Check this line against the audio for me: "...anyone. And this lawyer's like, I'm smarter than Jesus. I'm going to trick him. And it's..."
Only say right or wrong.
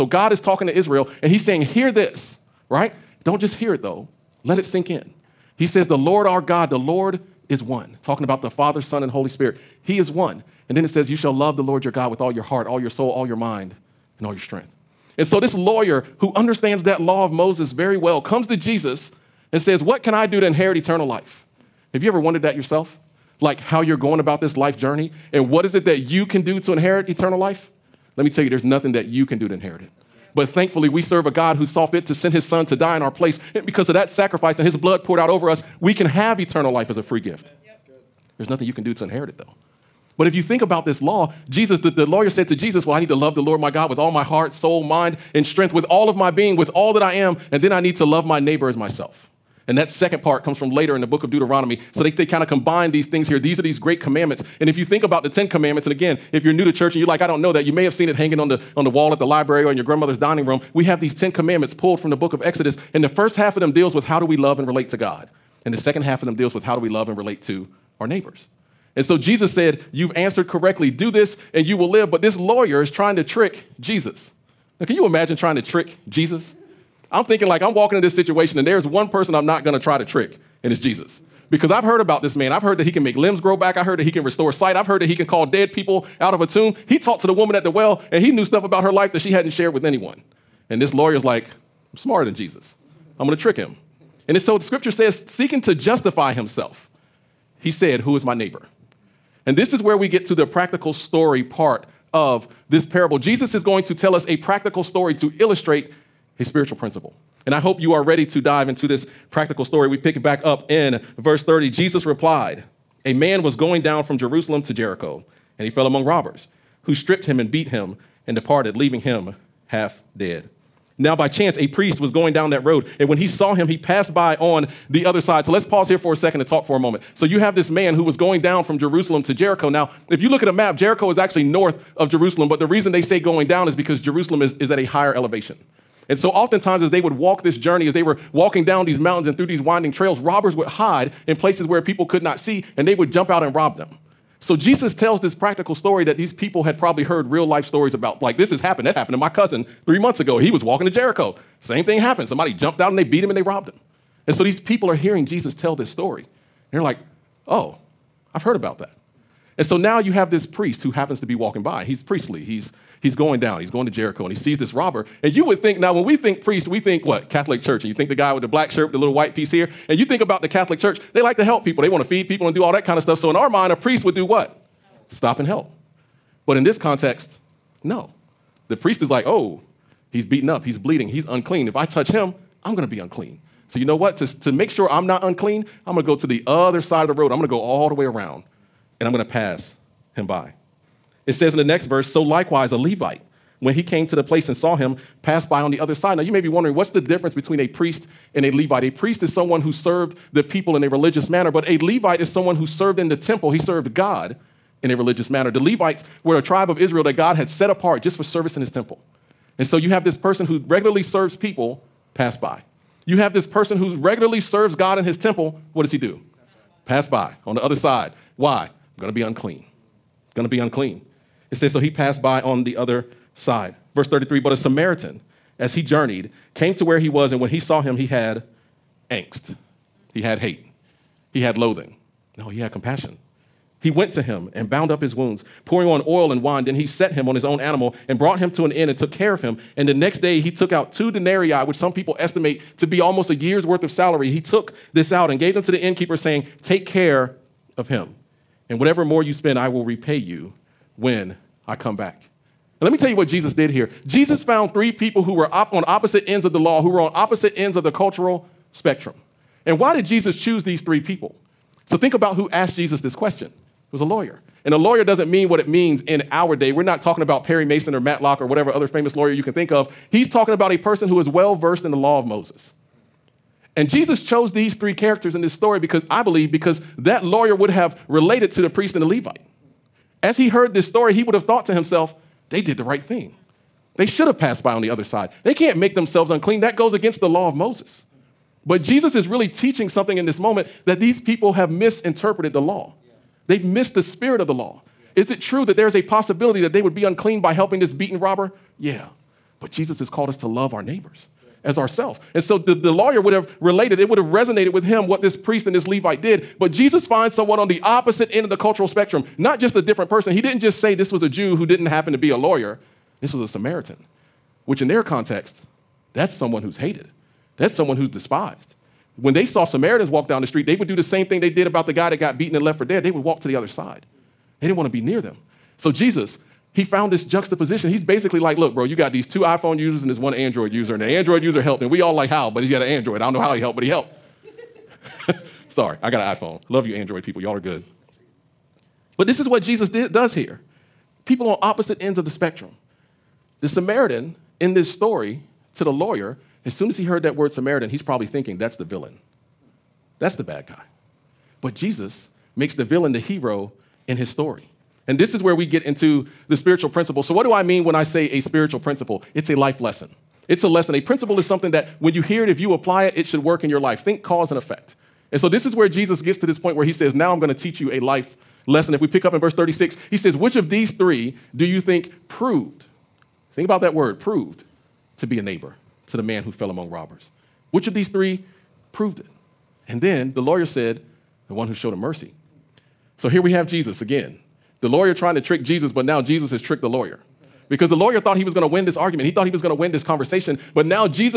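right.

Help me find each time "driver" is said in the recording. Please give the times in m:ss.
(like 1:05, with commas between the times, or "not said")
not said.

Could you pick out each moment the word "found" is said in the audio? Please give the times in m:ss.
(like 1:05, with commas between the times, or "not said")
4:14, 5:26.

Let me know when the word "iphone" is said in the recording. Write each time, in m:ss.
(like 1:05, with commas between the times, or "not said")
5:29, 5:36.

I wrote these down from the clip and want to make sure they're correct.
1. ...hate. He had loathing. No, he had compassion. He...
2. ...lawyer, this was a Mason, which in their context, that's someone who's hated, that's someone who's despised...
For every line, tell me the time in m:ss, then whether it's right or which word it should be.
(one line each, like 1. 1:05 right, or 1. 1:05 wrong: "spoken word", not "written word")
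1. 3:50 right
2. 5:12 wrong: "Samaritan", not "Mason".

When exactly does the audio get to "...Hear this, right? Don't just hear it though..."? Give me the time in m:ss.
0:01.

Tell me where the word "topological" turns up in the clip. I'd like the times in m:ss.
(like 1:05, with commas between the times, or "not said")
not said.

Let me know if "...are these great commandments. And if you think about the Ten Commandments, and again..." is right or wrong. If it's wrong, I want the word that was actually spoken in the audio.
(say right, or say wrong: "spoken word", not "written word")
right.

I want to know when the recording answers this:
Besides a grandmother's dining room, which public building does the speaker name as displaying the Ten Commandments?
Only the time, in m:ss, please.
0:59.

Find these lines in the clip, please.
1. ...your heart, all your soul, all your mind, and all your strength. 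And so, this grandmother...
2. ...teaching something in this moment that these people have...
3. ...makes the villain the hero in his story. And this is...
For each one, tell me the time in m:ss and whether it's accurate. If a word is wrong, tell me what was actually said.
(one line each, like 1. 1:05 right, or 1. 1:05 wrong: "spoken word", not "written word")
1. 0:12 wrong: "lawyer", not "grandmother"
2. 4:49 right
3. 5:52 right.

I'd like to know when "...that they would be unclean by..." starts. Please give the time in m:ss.
4:56.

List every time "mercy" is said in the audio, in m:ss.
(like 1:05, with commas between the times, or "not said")
6:21.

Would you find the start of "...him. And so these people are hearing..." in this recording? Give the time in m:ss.
2:33.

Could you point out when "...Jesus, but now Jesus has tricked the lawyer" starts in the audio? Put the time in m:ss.
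6:25.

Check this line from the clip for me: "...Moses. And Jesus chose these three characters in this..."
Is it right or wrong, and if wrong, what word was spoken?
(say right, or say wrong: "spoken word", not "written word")
right.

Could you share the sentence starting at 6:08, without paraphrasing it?
If we pick up in verse 36, he says, Which of these three do you think proved?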